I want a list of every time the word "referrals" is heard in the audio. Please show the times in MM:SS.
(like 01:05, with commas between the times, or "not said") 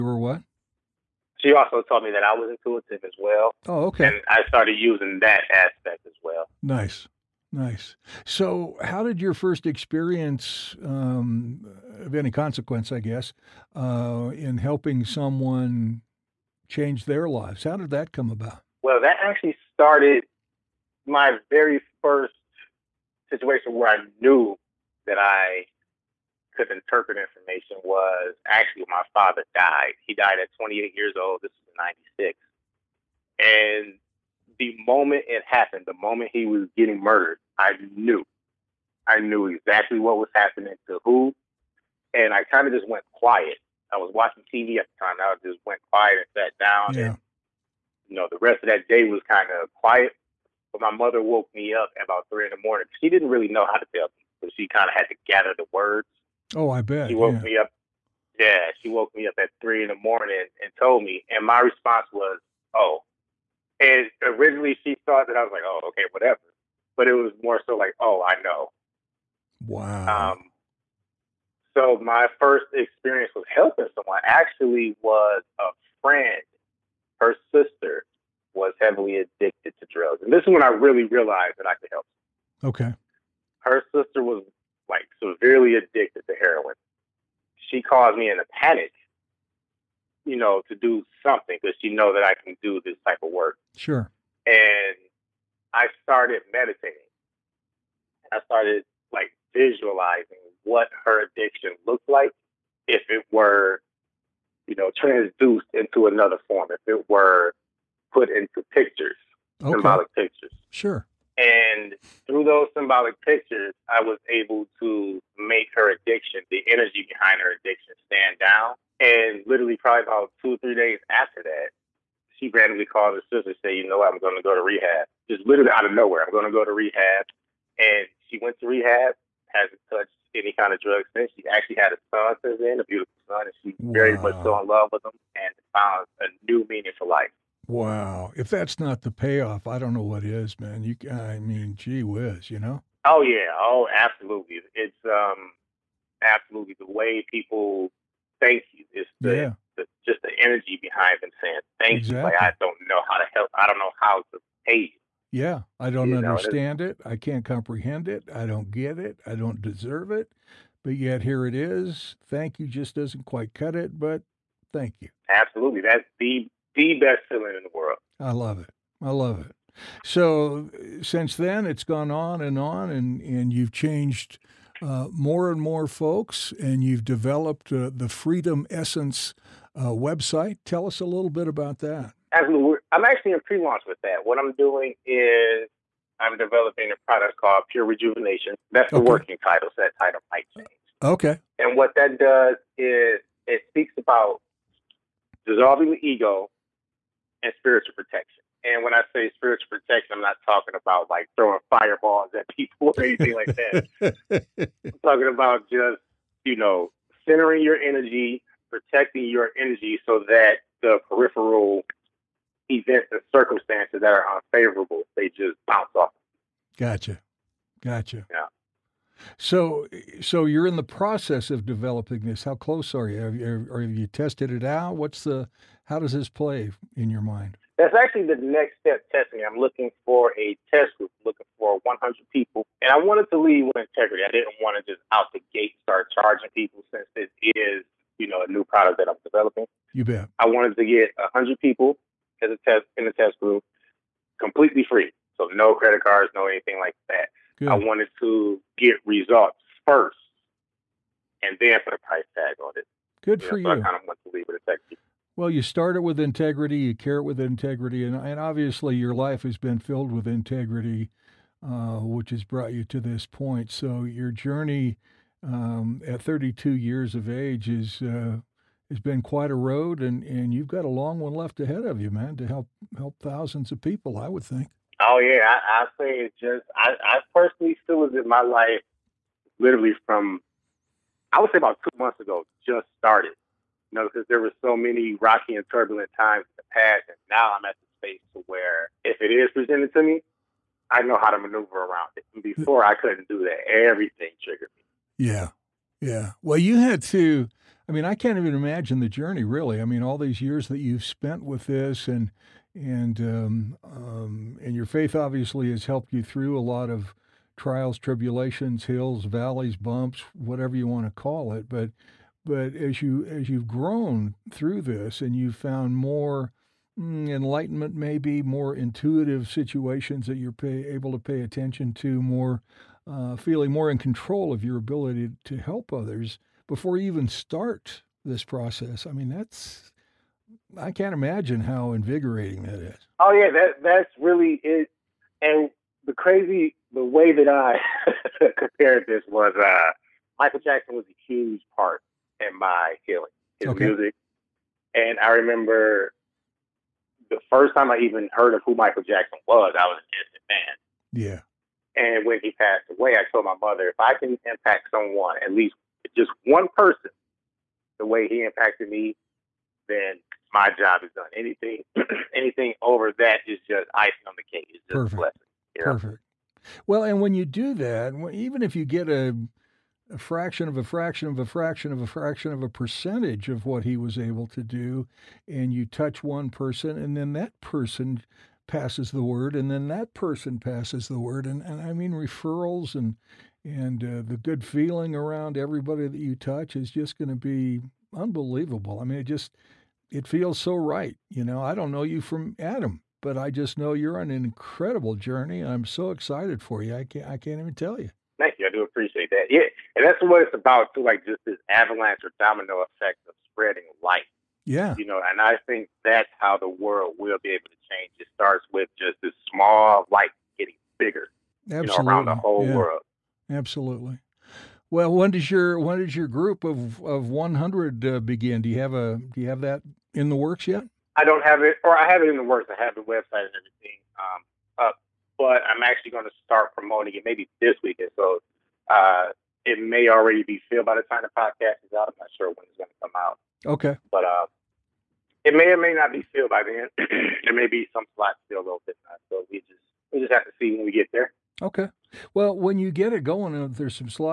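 06:22.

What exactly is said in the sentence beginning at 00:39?
I knew exactly what was happening to who.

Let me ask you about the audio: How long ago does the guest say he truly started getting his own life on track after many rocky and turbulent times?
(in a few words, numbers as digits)
2 months ago.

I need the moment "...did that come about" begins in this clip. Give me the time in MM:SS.
00:17.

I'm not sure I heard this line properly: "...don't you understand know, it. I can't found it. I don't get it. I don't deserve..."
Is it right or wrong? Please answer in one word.
wrong.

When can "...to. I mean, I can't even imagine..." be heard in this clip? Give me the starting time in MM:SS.
04:57.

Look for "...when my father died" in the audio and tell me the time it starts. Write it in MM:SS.
00:28.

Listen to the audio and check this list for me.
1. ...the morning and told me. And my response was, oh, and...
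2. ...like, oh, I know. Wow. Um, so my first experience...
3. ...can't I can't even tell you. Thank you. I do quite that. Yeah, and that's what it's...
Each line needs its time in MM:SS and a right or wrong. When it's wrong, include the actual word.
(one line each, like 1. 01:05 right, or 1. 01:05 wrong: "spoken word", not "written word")
1. 00:59 right
2. 01:07 right
3. 06:37 wrong: "appreciate", not "quite".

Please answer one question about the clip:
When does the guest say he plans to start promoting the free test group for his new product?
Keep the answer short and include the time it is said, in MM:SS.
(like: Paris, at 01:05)
This weekend, at 07:07.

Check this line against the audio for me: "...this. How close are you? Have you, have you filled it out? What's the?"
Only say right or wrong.
wrong.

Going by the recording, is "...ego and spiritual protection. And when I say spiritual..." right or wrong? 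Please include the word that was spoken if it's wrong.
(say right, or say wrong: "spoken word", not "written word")
right.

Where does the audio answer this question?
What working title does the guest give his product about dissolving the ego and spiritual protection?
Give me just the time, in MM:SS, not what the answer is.
03:07.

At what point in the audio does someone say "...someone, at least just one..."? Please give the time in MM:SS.
05:54.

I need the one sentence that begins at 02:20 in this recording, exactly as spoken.
You, I mean, gee whiz, you know?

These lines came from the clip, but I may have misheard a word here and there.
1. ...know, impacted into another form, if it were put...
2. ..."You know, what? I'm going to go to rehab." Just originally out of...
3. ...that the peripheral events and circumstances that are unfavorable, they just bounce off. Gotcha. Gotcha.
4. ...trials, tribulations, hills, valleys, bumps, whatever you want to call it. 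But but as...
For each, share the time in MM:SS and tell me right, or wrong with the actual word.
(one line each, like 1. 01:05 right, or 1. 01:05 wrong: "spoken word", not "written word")
1. 01:44 wrong: "transduced", not "impacted"
2. 02:03 wrong: "literally", not "originally"
3. 03:30 right
4. 05:07 right.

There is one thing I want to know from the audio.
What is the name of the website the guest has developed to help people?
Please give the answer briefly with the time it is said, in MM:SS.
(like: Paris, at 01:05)
Freedom Essence, at 02:58.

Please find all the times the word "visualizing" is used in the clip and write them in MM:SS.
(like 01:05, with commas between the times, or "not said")
01:39.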